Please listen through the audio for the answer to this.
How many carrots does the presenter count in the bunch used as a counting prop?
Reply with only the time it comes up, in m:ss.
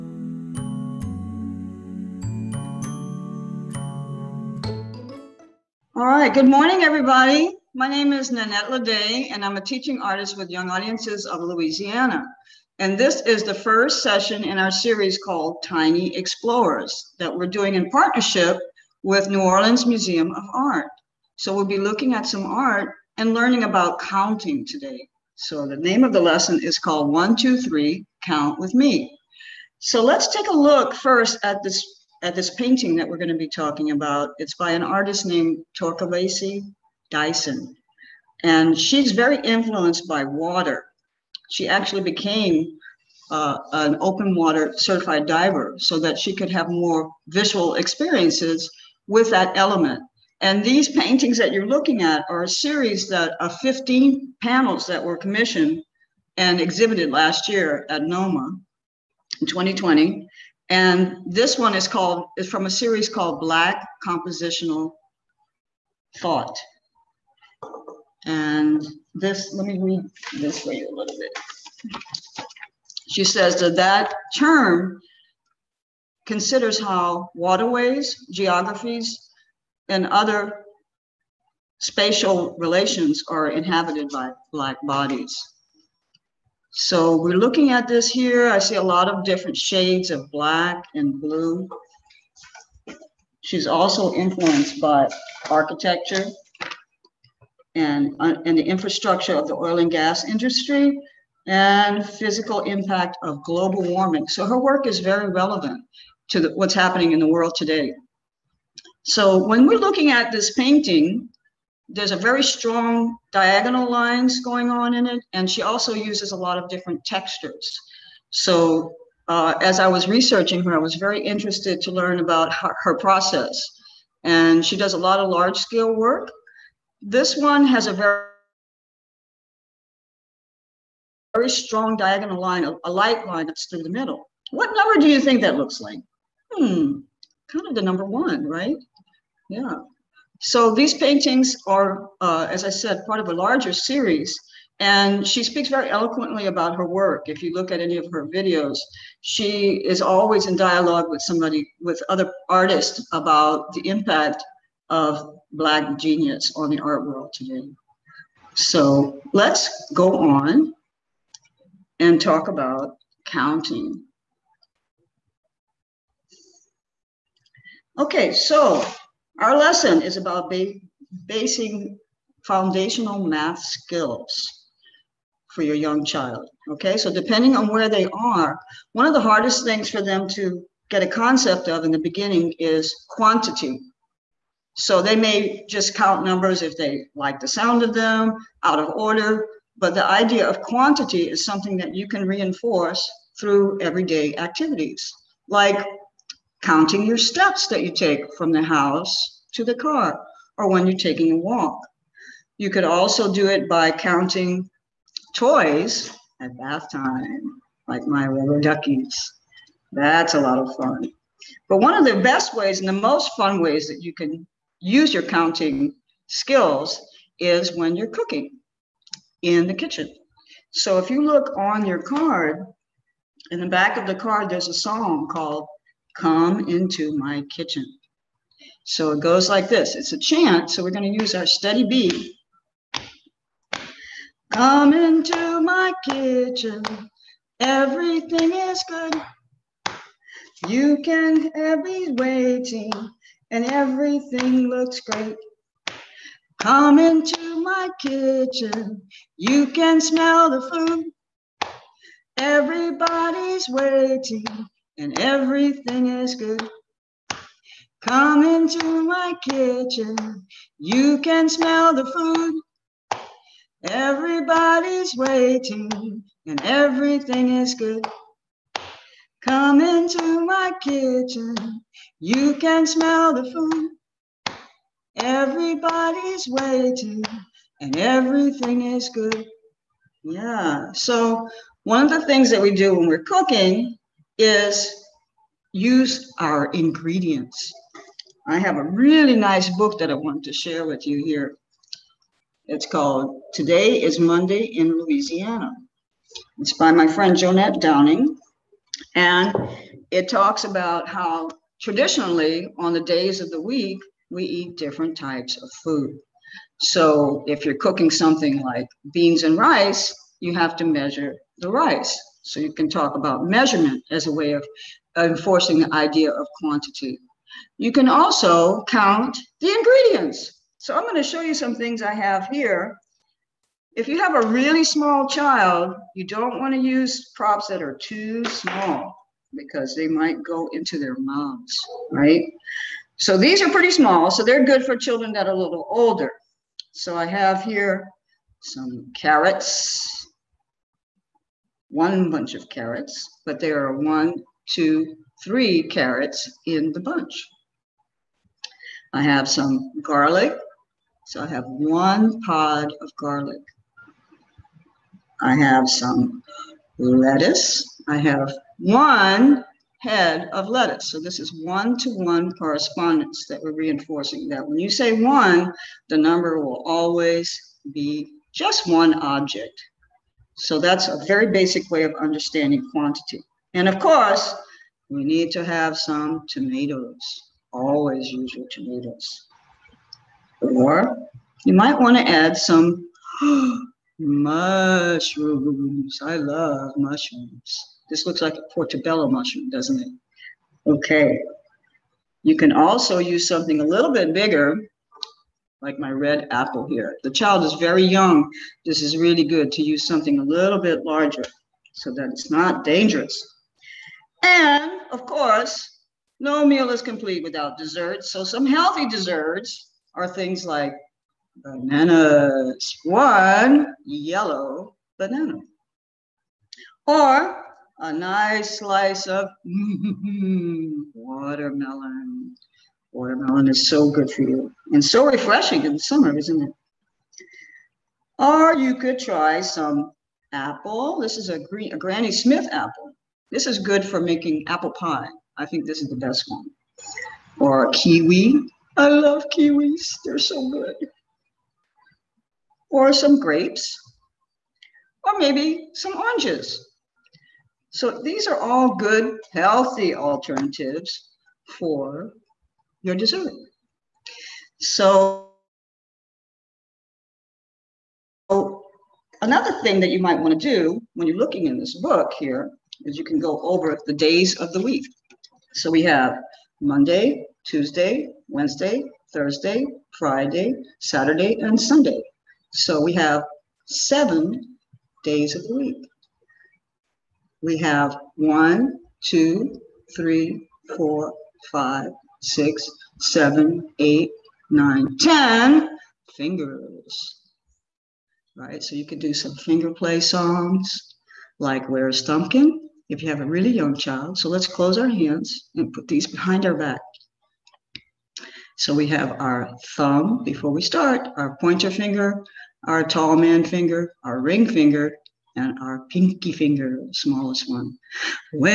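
5:45.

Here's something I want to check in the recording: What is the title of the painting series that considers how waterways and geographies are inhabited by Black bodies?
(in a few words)
Black Compositional Thought.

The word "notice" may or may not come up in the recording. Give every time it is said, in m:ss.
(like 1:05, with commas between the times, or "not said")
not said.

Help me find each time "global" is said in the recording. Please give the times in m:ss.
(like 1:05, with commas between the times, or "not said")
1:43.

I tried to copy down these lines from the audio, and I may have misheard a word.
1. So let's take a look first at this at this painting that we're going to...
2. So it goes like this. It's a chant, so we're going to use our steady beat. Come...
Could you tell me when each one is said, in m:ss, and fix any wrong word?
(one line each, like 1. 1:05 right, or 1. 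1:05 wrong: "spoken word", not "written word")
1. 0:29 right
2. 3:48 right.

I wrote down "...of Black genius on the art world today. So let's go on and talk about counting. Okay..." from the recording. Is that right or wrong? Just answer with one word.
right.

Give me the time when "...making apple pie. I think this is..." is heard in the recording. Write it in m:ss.
7:14.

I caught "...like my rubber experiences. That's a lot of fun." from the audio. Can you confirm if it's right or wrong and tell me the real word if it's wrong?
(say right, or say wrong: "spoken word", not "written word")
wrong: "duckies", not "experiences".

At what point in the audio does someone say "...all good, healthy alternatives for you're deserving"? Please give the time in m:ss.
7:28.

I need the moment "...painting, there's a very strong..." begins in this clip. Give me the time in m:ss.
1:50.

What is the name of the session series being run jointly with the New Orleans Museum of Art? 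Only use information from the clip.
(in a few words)
Tiny Explorers.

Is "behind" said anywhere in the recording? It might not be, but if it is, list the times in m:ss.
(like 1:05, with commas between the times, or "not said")
8:16.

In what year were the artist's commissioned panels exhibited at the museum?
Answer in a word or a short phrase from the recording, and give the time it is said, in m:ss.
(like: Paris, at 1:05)
2020, at 0:59.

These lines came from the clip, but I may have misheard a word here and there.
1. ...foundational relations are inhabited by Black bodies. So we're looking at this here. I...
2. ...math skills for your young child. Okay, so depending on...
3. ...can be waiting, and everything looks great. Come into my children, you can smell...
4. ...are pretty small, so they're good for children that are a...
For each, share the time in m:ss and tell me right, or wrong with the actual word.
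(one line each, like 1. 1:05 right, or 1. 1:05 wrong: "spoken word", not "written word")
1. 1:21 wrong: "spatial", not "foundational"
2. 2:53 right
3. 4:01 wrong: "kitchen", not "children"
4. 5:33 right.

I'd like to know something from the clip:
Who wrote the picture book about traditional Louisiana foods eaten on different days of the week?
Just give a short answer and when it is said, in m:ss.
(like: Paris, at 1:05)
Johnette Downing, at 4:57.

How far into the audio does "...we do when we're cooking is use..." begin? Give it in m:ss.
4:42.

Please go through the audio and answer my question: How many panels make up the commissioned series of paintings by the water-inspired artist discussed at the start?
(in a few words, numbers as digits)
15.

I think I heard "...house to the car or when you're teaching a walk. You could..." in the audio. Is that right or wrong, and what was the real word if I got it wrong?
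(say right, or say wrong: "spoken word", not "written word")
wrong: "taking", not "teaching".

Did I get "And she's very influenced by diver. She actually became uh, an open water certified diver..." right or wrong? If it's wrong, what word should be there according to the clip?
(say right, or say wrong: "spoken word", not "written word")
wrong: "water", not "diver".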